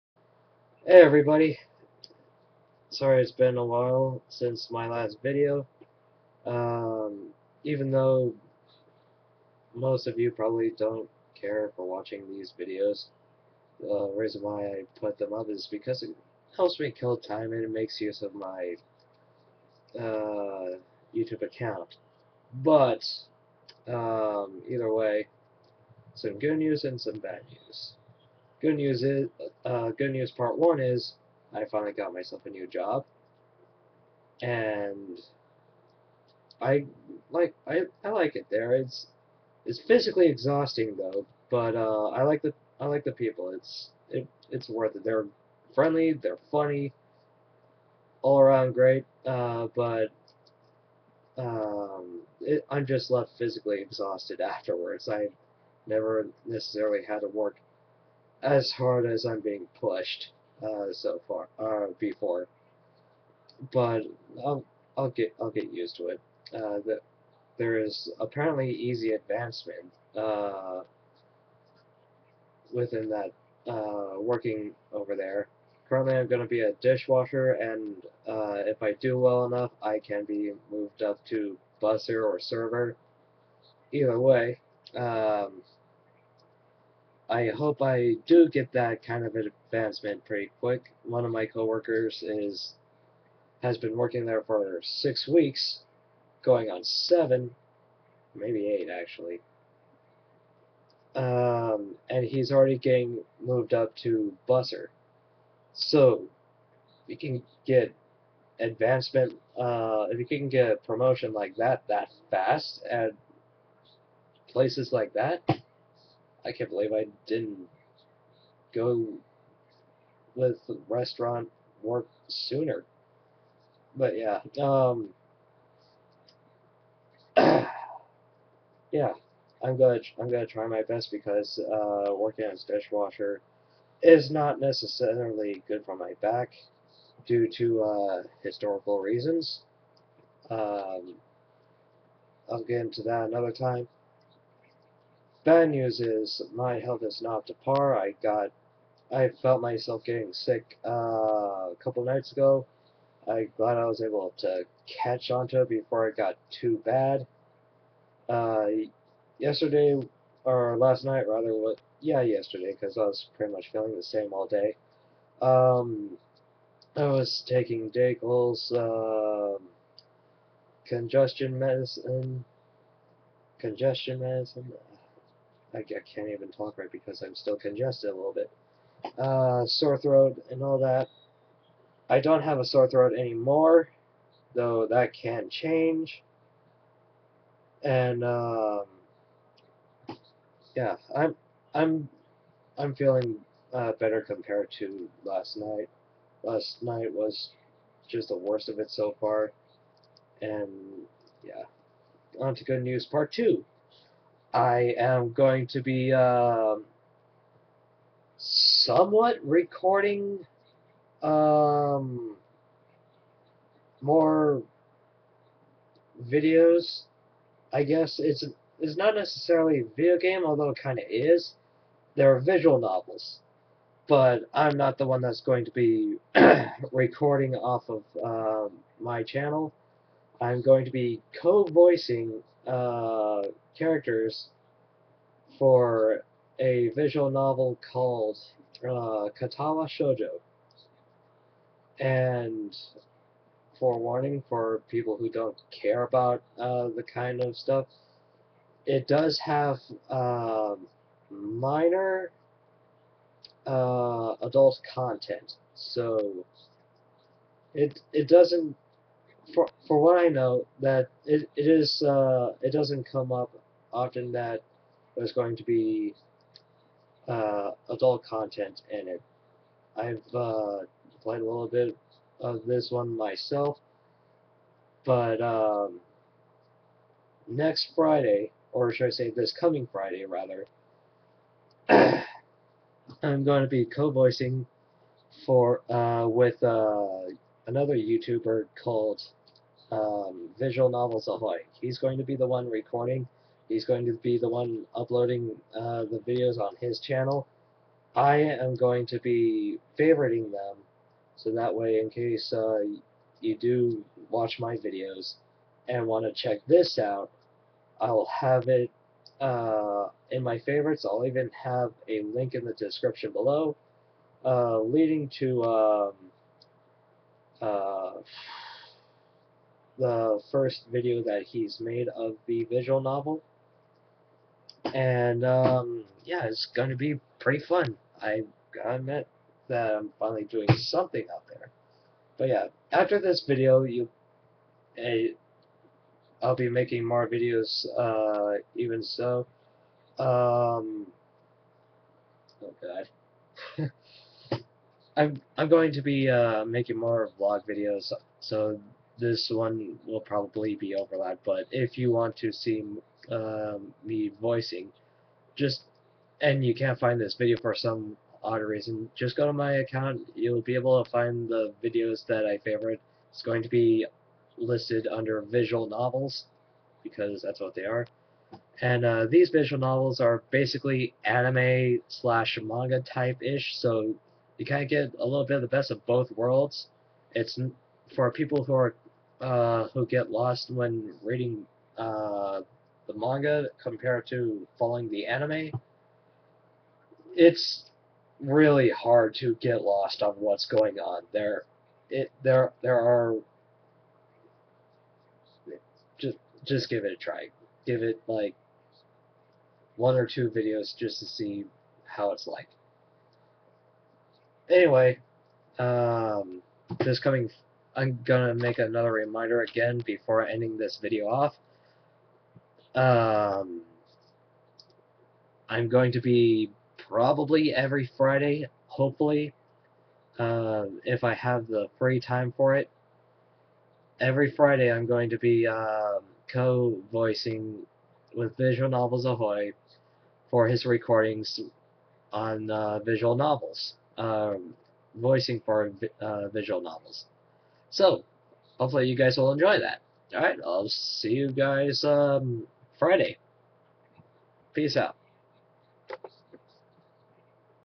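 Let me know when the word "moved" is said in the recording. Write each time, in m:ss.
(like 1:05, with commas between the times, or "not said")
1:20, 1:43.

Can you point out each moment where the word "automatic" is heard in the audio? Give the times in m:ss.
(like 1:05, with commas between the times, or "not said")
not said.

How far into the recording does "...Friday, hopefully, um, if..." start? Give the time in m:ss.
6:58.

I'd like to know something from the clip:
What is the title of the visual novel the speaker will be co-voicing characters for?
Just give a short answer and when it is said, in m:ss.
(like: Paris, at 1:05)
Katawa Shoujo, at 3:59.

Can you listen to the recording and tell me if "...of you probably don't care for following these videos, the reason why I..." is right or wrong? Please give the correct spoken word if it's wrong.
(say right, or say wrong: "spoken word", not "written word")
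wrong: "watching", not "following".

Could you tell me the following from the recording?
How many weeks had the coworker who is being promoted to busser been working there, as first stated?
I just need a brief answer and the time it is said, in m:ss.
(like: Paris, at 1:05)
6, at 1:34.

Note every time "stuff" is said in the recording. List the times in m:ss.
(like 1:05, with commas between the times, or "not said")
4:07.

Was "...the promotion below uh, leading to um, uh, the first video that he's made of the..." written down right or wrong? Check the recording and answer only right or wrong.
wrong.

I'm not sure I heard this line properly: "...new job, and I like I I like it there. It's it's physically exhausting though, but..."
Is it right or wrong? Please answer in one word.
right.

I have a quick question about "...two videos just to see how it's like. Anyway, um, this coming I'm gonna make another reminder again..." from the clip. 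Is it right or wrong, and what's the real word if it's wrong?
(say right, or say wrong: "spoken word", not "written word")
right.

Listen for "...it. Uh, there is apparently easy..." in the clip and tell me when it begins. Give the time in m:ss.
1:06.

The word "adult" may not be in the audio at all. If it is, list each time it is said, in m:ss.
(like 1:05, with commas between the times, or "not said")
4:13, 4:27.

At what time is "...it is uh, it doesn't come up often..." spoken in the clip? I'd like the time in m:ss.
4:21.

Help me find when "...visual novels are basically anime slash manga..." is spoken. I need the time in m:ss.
6:09.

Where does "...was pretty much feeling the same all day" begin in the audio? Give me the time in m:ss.
2:43.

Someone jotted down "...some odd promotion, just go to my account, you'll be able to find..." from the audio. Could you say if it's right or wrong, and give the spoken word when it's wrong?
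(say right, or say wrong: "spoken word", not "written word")
wrong: "reason", not "promotion".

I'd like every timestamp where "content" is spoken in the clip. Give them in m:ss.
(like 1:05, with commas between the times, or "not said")
4:14, 4:28.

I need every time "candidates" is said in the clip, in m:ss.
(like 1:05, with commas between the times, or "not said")
not said.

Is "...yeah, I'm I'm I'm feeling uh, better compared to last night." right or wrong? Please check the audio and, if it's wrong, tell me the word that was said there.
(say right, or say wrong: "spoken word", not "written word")
right.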